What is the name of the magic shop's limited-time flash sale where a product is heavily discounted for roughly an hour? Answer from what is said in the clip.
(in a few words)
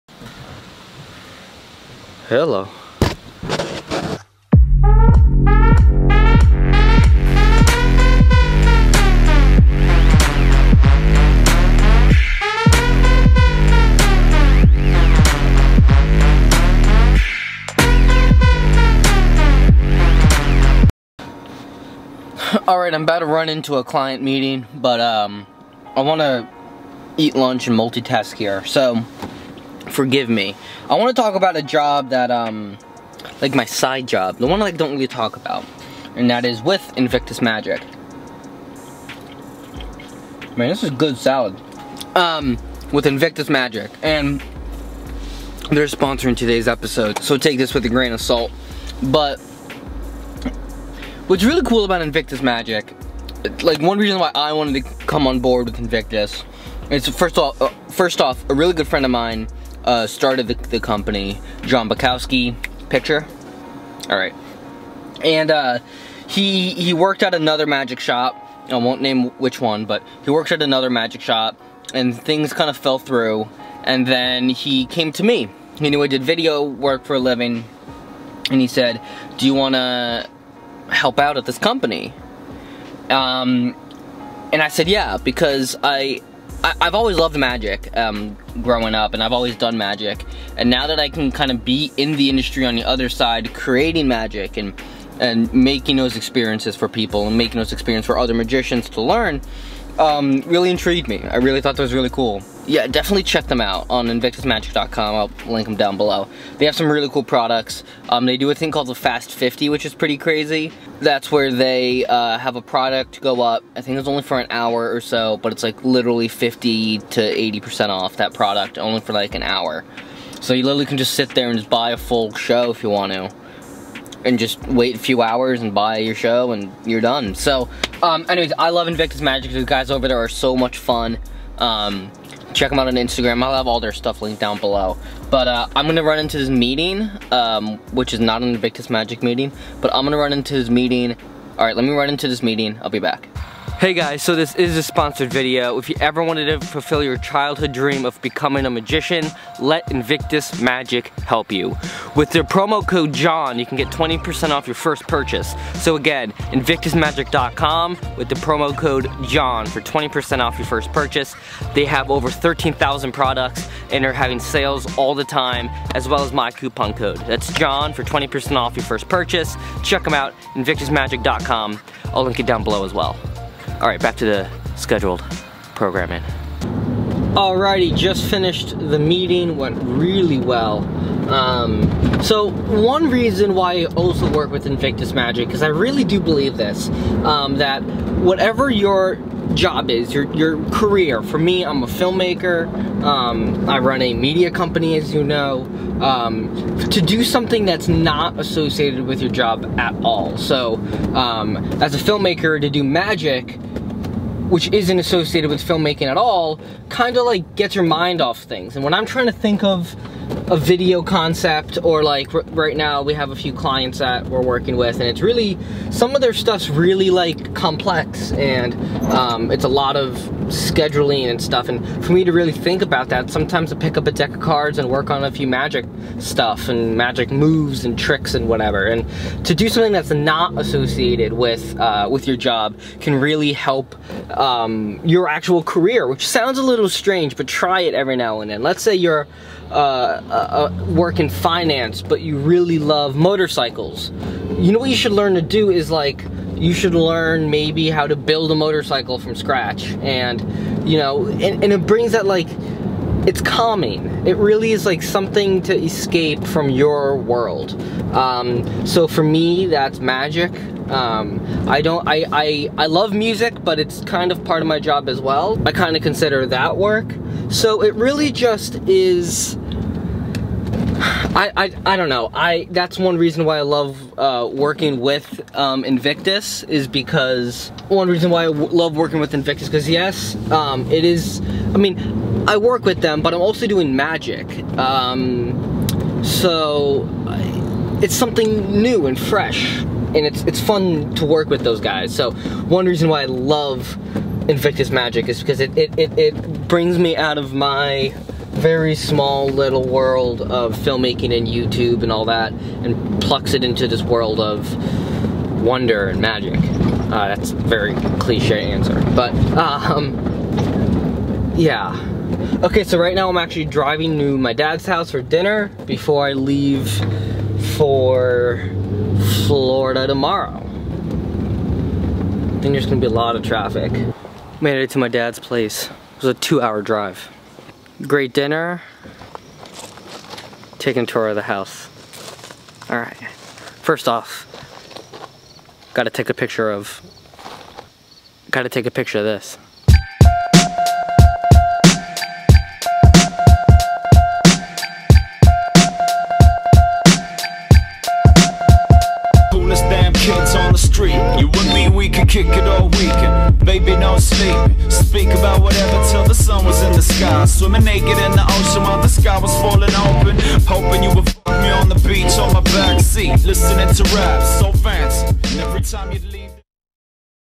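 Fast 50.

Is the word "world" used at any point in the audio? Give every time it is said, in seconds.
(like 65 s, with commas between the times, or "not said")
257 s, 299 s, 304 s.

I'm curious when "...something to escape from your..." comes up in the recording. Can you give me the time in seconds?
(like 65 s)
255 s.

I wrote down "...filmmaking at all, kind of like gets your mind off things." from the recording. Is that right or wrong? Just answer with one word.
right.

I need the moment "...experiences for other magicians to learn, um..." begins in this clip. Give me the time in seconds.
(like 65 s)
97 s.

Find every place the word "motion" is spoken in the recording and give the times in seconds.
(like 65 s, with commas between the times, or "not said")
not said.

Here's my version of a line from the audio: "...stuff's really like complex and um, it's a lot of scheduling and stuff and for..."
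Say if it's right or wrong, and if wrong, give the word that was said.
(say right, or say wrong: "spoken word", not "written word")
right.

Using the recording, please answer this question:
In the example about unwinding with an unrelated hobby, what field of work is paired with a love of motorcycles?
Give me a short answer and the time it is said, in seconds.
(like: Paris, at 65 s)
finance, at 241 s.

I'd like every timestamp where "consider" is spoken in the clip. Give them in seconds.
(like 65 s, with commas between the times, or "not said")
266 s.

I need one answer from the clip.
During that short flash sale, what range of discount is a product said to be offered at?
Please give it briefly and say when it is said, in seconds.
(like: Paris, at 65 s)
50 to 80%, at 116 s.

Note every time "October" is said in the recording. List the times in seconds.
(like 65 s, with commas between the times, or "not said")
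not said.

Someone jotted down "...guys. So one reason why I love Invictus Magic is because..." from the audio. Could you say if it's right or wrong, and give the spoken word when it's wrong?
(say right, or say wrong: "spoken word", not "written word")
right.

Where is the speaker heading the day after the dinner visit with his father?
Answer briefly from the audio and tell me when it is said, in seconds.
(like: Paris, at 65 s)
Florida, at 319 s.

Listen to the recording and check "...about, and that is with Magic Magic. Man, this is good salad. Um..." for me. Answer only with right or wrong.
wrong.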